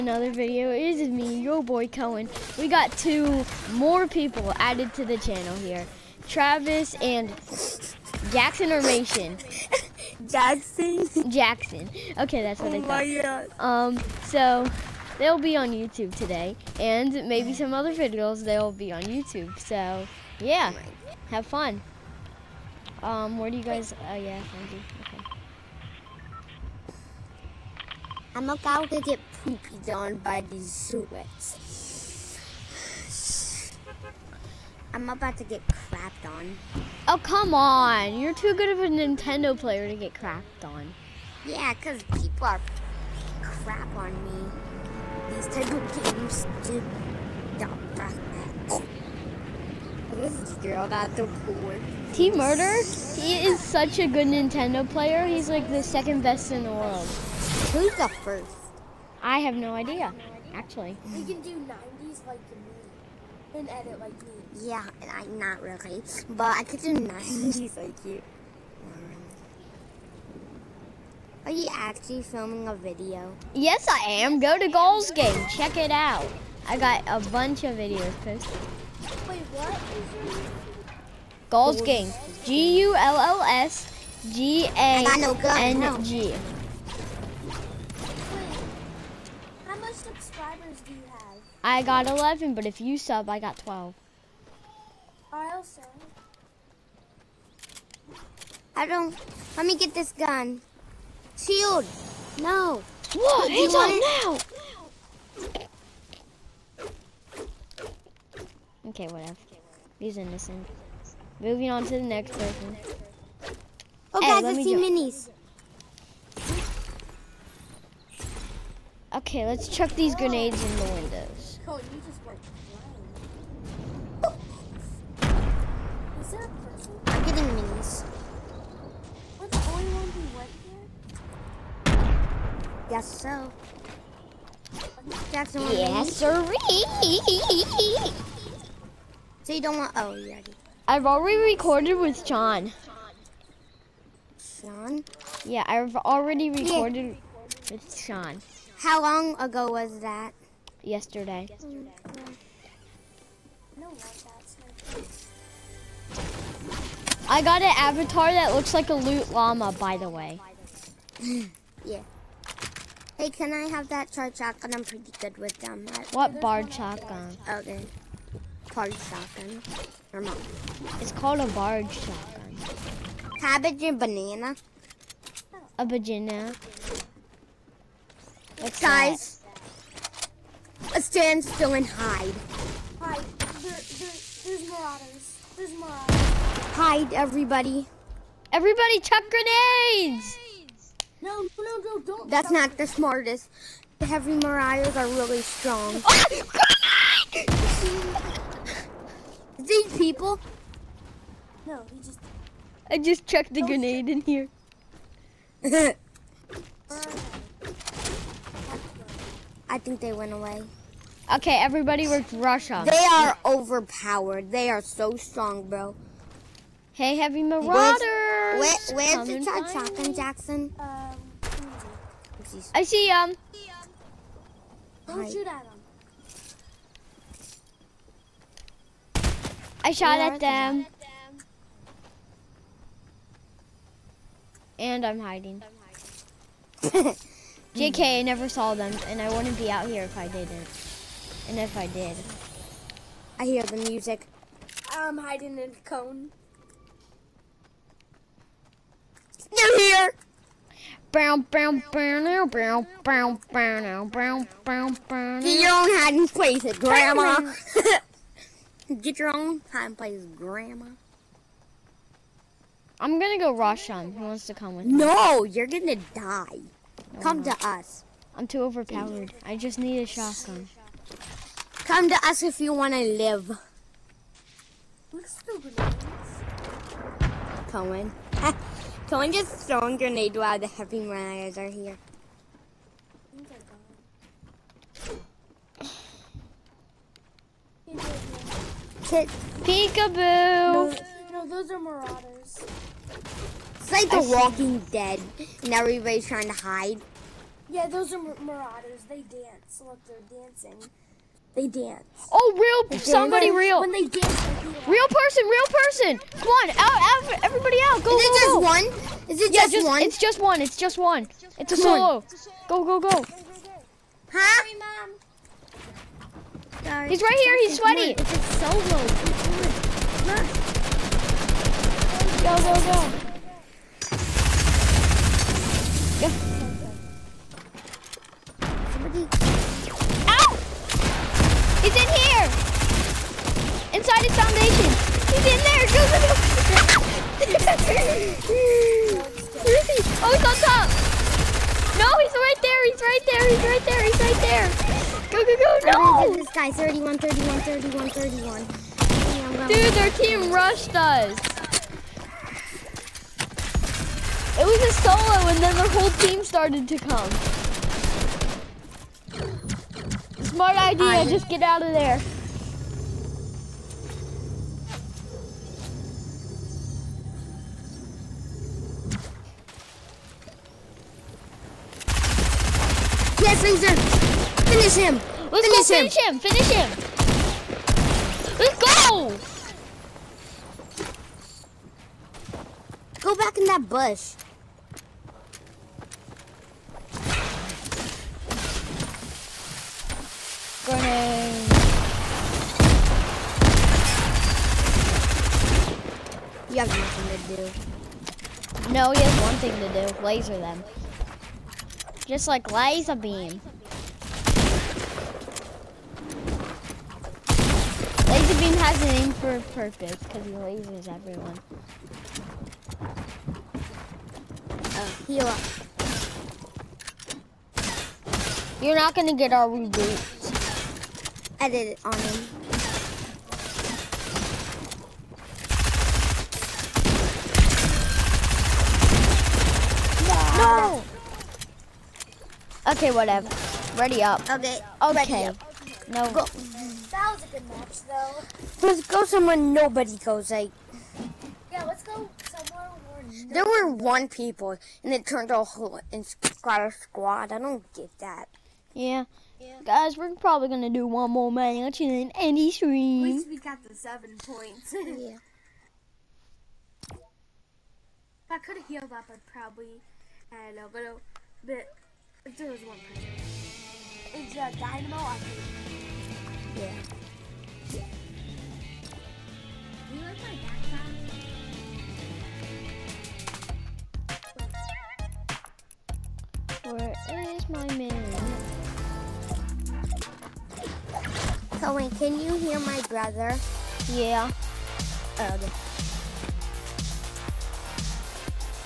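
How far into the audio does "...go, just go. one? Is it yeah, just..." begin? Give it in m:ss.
5:08.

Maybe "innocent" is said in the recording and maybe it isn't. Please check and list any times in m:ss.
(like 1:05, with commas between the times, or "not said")
1:50.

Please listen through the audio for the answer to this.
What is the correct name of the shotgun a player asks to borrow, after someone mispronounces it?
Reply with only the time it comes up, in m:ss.
2:51.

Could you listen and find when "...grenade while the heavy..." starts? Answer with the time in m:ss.
4:39.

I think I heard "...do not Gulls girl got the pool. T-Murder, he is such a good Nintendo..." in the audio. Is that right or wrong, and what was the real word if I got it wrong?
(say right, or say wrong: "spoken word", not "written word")
wrong: "This", not "Gulls".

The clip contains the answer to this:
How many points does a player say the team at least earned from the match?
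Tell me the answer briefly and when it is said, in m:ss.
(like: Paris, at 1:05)
7, at 7:33.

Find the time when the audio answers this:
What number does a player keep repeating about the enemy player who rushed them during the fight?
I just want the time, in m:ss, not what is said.
5:46.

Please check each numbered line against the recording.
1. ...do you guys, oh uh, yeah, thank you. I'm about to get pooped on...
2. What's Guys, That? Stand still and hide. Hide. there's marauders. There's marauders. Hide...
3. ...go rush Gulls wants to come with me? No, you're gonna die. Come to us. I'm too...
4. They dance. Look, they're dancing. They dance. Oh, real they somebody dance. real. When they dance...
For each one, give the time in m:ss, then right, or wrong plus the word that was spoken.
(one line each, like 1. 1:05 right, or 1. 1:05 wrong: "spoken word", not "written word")
1. 0:23 right
2. 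2:58 right
3. 4:23 wrong: "Who", not "Gulls"
4. 4:59 right.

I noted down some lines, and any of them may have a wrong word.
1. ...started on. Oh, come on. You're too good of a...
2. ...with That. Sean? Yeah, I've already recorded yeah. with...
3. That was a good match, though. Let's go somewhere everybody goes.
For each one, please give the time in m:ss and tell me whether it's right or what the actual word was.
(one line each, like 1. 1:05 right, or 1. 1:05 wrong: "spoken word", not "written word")
1. 0:35 wrong: "crapped", not "started"
2. 2:21 wrong: "John", not "That"
3. 7:17 wrong: "nobody", not "everybody".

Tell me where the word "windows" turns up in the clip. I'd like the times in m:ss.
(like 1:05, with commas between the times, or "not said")
2:00.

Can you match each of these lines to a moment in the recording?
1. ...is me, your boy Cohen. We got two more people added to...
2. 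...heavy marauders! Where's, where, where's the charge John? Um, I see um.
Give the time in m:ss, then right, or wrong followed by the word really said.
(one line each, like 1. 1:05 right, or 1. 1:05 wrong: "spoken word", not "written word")
1. 0:00 right
2. 3:37 wrong: "Jackson", not "John".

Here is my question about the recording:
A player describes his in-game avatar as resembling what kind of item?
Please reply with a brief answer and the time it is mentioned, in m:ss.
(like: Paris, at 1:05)
Loot llama, at 2:38.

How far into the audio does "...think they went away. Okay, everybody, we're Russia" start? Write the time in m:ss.
3:29.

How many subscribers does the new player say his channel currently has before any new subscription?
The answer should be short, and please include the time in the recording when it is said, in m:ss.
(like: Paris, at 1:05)
11, at 1:31.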